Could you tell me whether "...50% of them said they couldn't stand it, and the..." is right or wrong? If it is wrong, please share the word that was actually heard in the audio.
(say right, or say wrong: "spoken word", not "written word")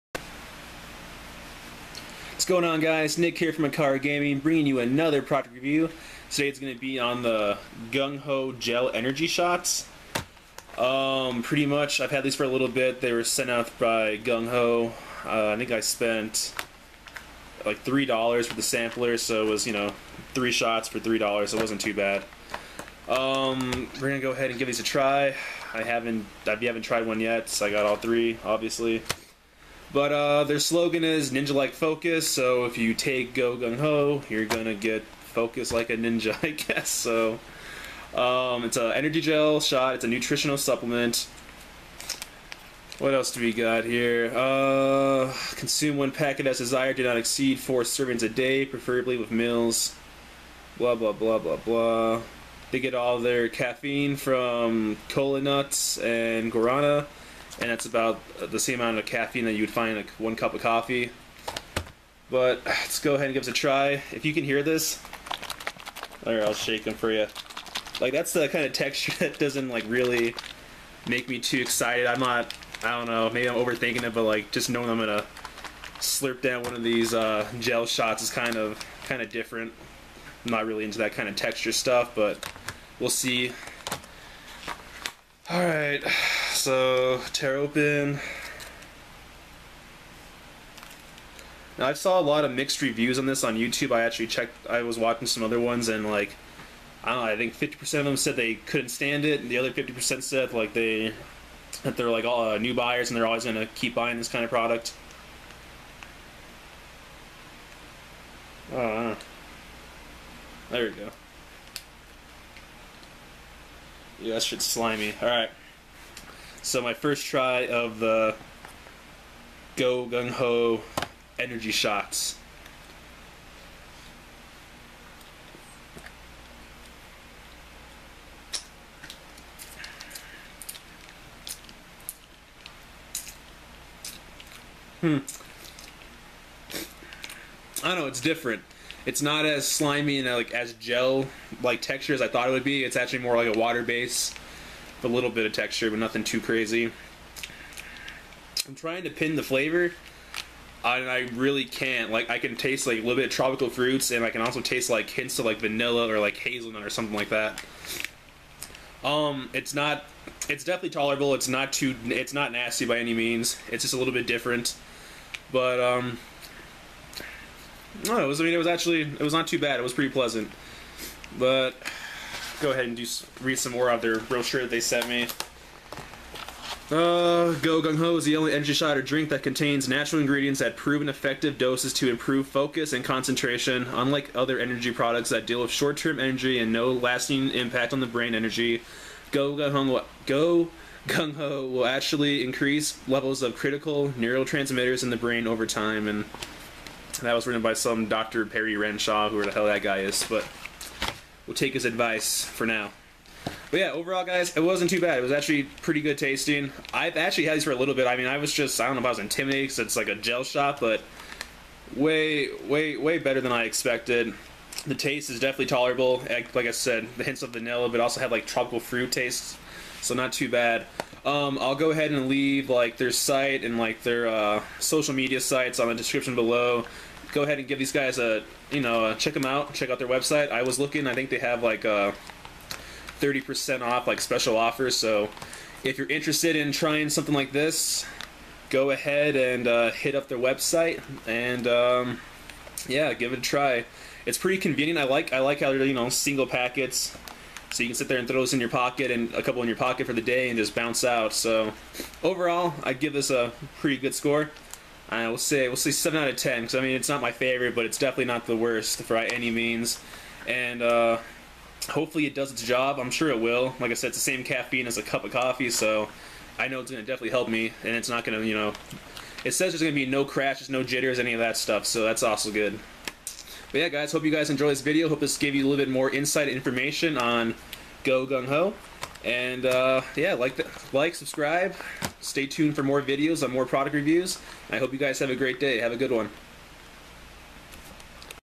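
right.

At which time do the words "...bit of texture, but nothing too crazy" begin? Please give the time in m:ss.
2:25.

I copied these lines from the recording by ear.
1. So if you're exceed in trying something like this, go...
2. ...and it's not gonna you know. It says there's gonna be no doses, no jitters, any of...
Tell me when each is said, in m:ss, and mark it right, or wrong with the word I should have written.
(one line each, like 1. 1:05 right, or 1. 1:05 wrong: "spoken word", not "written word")
1. 3:54 wrong: "interested", not "exceed"
2. 4:27 wrong: "crashes", not "doses".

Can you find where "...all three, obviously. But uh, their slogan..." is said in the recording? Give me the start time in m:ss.
0:27.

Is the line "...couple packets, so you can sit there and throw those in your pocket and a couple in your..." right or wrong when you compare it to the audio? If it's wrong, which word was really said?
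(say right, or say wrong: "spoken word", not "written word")
wrong: "single", not "couple".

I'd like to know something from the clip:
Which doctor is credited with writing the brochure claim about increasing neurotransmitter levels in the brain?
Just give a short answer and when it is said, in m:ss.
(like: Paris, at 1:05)
Dr. Perry Renshaw, at 3:18.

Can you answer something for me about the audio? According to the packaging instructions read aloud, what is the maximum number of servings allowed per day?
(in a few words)
4.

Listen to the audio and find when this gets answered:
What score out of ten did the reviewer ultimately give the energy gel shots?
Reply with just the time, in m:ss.
4:15.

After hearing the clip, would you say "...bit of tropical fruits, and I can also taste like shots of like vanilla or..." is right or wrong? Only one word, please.
wrong.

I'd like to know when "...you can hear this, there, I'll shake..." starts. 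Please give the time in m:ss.
1:04.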